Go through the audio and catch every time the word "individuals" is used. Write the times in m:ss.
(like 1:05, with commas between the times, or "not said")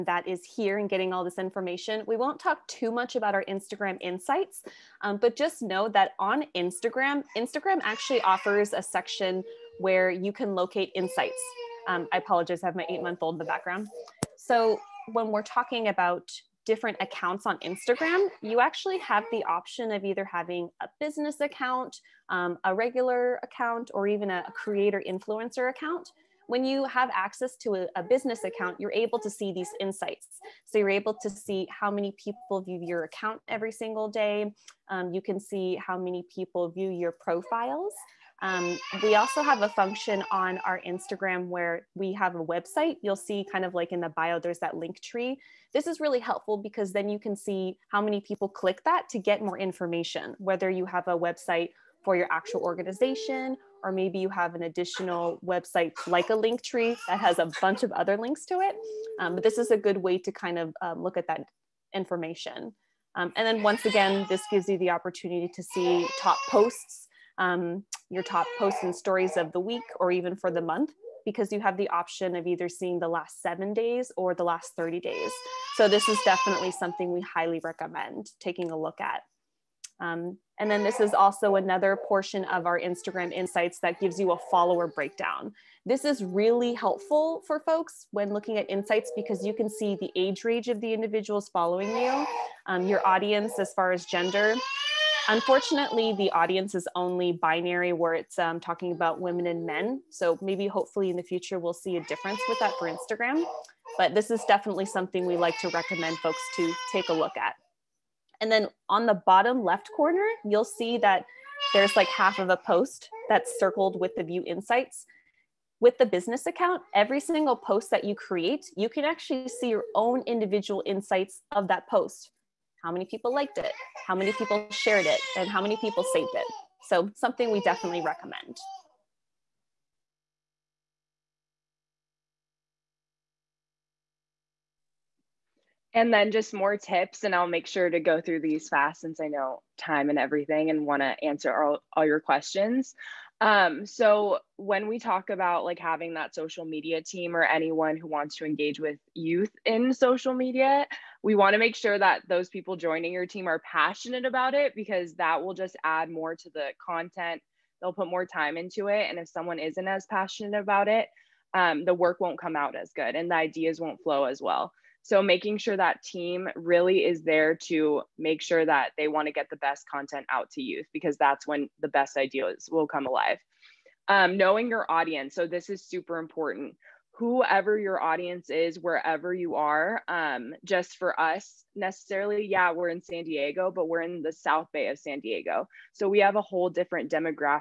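1:30, 2:00.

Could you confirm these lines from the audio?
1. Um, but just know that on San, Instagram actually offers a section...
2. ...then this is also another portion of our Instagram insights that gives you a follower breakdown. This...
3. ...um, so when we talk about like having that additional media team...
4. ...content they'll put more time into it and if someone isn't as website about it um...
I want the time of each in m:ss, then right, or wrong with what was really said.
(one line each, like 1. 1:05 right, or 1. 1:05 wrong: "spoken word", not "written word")
1. 0:05 wrong: "Instagram", not "San"
2. 1:20 right
3. 2:23 wrong: "social", not "additional"
4. 2:36 wrong: "passionate", not "website".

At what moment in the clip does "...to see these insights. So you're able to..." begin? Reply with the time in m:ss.
0:29.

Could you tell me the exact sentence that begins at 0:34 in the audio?
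Um, you can see how many people view your profiles.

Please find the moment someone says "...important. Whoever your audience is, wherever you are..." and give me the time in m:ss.
2:56.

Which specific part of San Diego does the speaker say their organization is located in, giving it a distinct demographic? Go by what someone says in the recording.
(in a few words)
South Bay.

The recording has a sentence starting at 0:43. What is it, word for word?
You'll see kind of like in the bio, there's that Linktree.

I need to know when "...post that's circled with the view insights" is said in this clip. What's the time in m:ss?
1:52.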